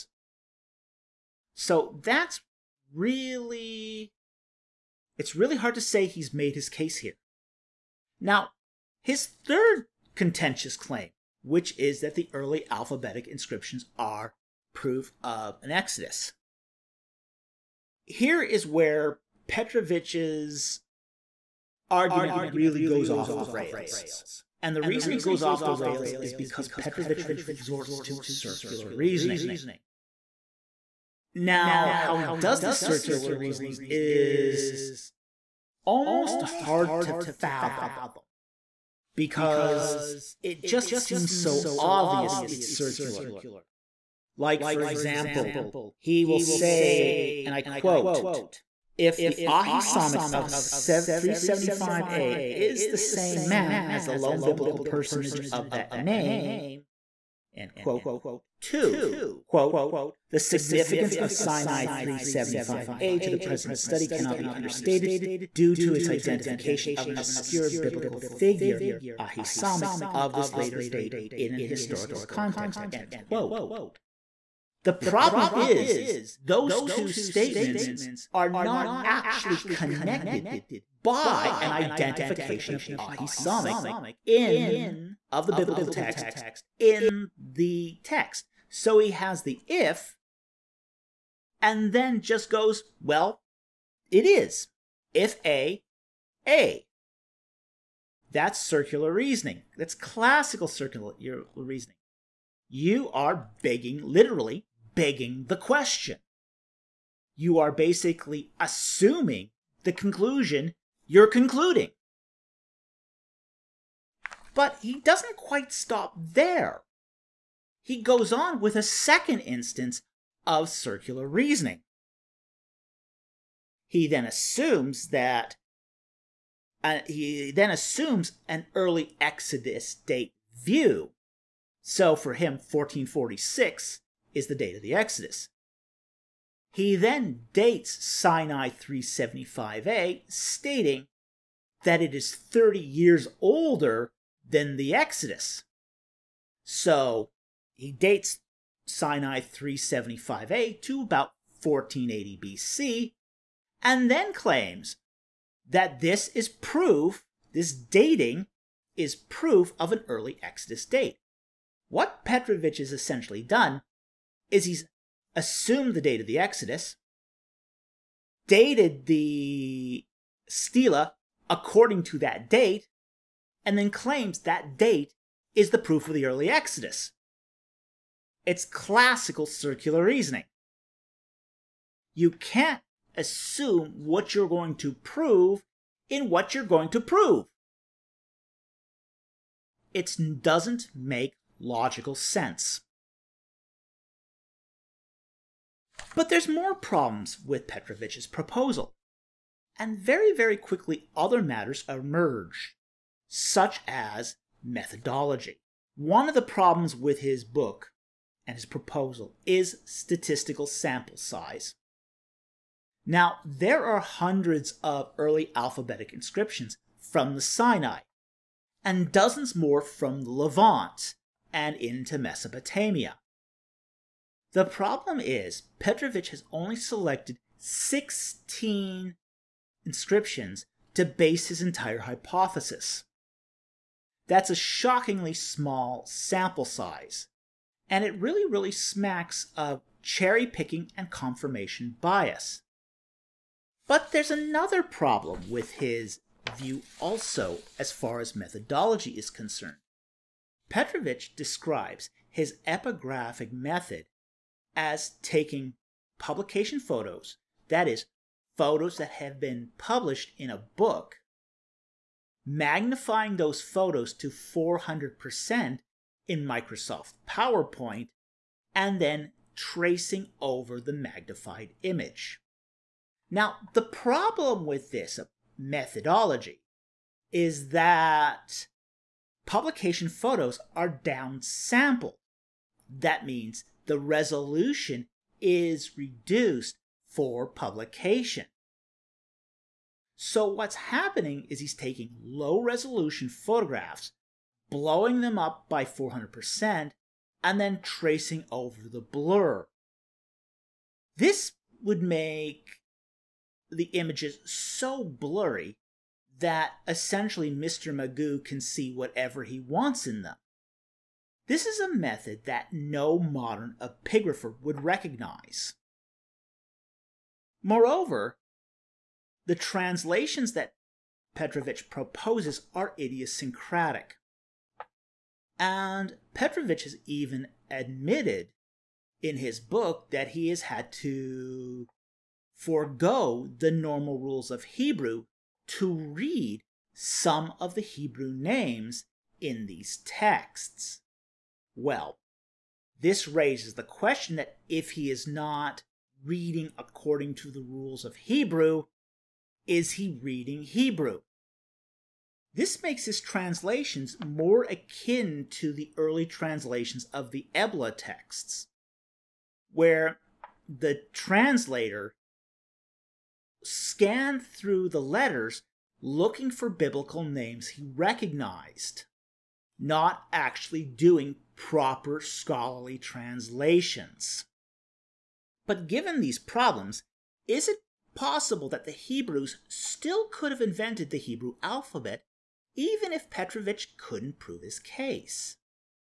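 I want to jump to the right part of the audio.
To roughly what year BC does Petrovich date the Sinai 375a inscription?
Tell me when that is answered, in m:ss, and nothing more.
2:31.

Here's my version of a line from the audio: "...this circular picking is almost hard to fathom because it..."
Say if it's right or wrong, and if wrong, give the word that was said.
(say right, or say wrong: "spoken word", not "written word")
wrong: "reasoning", not "picking".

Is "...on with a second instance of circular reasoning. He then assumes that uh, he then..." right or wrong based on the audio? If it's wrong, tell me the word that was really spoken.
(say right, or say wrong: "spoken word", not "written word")
right.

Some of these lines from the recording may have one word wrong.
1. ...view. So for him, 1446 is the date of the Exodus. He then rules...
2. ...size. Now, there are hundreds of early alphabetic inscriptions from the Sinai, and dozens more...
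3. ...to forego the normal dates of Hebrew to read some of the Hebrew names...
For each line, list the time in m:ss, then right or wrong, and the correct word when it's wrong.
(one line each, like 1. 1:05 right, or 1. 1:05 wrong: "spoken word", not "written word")
1. 2:10 wrong: "dates", not "rules"
2. 3:31 right
3. 5:30 wrong: "rules", not "dates".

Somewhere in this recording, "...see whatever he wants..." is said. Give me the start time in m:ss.
5:08.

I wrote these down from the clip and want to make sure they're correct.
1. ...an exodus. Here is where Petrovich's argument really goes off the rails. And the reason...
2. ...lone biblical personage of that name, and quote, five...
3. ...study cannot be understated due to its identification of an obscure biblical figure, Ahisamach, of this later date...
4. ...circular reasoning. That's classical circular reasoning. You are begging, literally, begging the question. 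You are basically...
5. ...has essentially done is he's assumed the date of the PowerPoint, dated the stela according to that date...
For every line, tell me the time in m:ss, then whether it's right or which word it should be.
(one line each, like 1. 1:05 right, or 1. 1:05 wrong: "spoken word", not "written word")
1. 0:15 right
2. 0:54 wrong: "two", not "five"
3. 1:03 right
4. 1:38 right
5. 2:42 wrong: "Exodus", not "PowerPoint".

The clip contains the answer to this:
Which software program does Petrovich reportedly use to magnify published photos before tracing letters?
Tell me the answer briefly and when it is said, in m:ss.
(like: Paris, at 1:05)
Microsoft PowerPoint, at 4:26.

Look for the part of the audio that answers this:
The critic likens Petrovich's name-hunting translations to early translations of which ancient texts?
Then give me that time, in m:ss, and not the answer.
5:57.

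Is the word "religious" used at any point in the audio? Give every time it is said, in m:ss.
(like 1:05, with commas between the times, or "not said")
not said.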